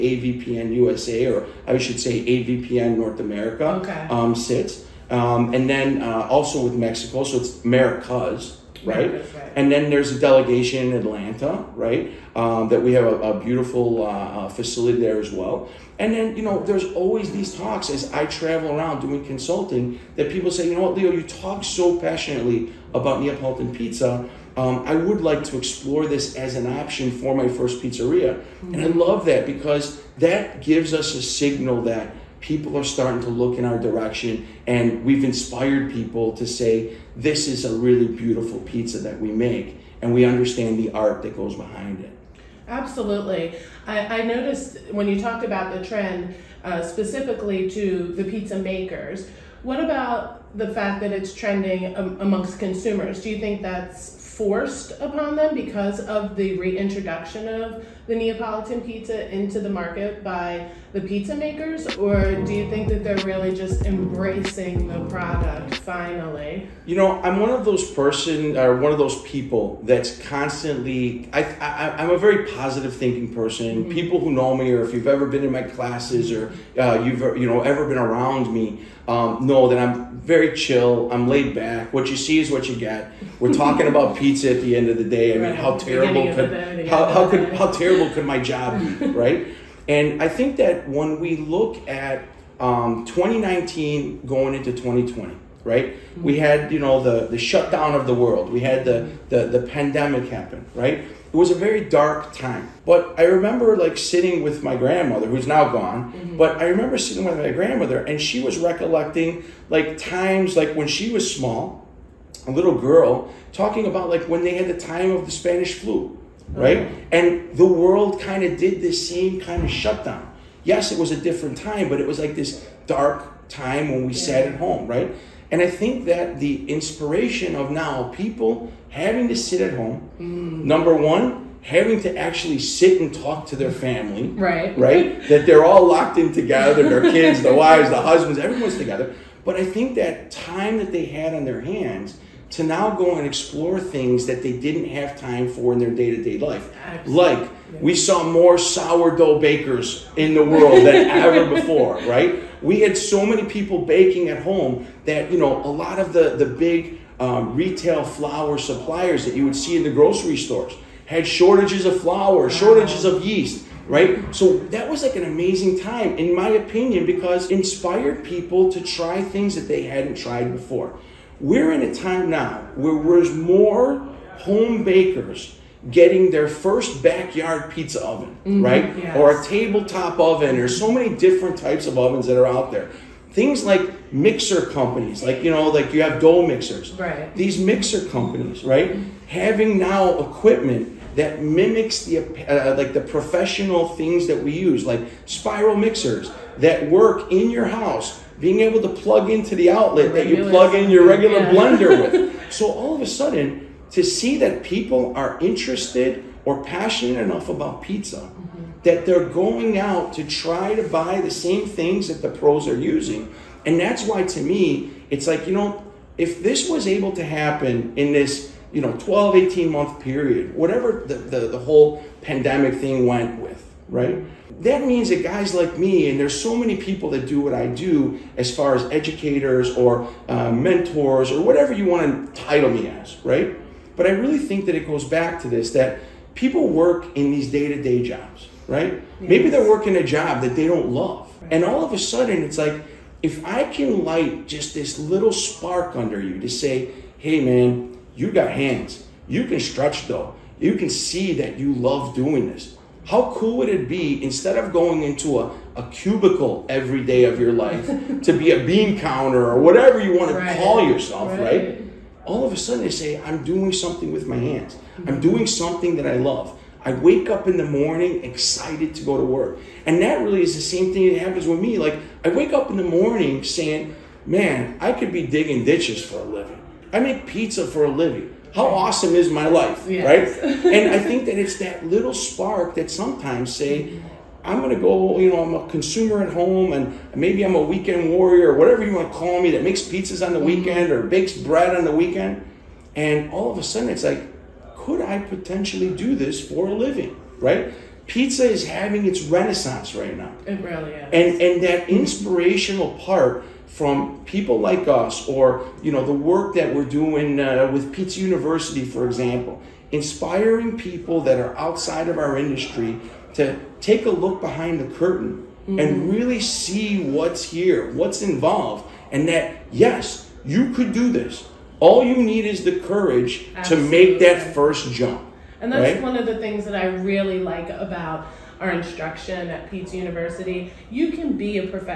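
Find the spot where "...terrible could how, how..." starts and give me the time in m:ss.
1:25.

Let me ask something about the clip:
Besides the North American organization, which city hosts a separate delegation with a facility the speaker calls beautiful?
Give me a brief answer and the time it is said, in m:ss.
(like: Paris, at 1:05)
Atlanta, at 0:10.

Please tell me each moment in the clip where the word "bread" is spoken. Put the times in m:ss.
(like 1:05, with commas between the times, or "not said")
4:51.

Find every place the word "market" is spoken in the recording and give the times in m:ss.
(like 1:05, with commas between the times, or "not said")
0:59.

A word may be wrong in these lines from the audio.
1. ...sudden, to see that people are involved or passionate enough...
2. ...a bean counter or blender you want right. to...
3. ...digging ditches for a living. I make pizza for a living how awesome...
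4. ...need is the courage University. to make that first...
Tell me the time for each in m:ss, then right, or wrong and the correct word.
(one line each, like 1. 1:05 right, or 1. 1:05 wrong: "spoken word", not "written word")
1. 3:23 wrong: "interested", not "involved"
2. 4:18 wrong: "whatever", not "blender"
3. 4:35 right
4. 5:22 wrong: "Absolutely", not "University".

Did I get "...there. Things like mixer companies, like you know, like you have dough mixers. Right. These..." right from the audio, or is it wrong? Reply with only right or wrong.
right.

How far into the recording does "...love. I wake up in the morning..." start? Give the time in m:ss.
4:26.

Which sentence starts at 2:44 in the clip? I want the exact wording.
So that was like an amazing time, in my opinion, because inspired people to try things that they hadn't tried before.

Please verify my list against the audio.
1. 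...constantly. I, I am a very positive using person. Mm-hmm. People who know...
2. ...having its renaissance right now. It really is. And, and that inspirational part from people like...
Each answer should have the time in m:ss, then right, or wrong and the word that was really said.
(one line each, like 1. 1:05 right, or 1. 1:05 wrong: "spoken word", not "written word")
1. 1:10 wrong: "thinking", not "using"
2. 4:58 right.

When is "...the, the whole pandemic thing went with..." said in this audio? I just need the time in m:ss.
3:41.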